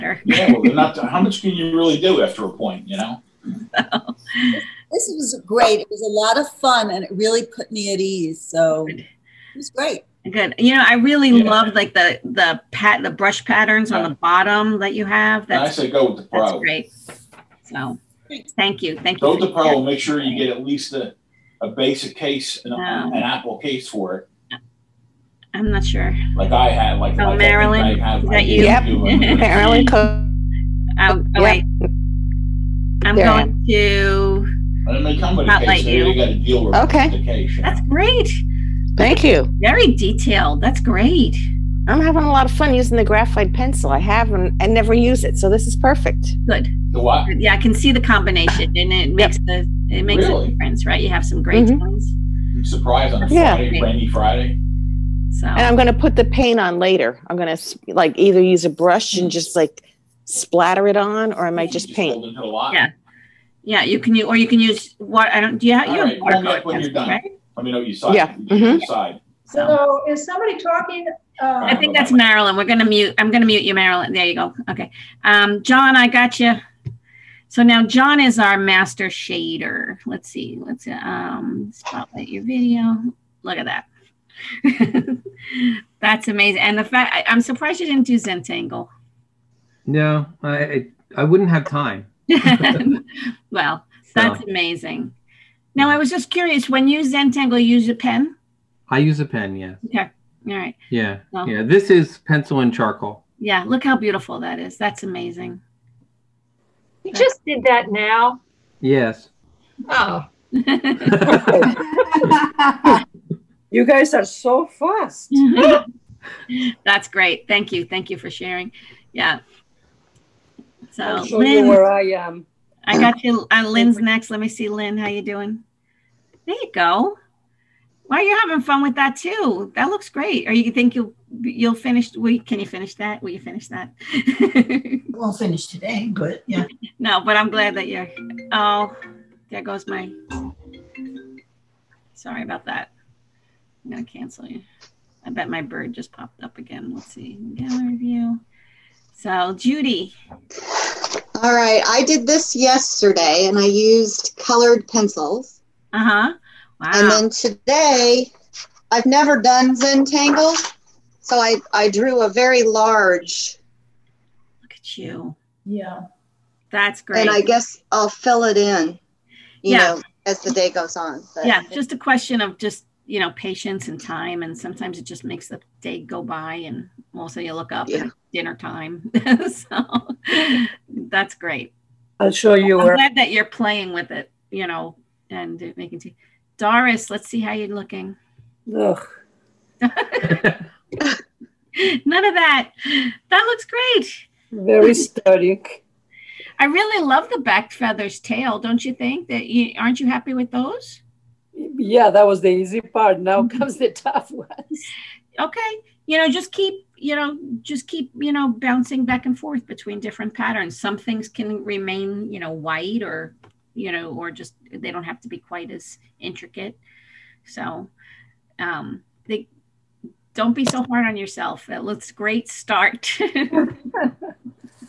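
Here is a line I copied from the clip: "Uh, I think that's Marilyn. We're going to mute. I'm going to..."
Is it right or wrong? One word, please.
right.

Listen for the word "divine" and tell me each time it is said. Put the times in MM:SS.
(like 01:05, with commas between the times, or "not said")
not said.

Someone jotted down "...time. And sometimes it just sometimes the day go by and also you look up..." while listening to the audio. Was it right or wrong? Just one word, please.
wrong.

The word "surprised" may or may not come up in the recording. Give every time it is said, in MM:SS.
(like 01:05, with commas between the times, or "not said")
00:52, 01:27.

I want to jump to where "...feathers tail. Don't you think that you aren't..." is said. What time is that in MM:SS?
03:17.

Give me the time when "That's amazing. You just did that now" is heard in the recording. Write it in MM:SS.
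01:44.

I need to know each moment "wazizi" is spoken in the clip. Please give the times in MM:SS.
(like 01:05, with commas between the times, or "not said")
not said.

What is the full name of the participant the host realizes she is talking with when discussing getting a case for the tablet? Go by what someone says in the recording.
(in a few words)
Marilyn Cook.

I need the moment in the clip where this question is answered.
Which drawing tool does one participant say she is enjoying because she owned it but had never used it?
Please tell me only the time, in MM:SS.
00:43.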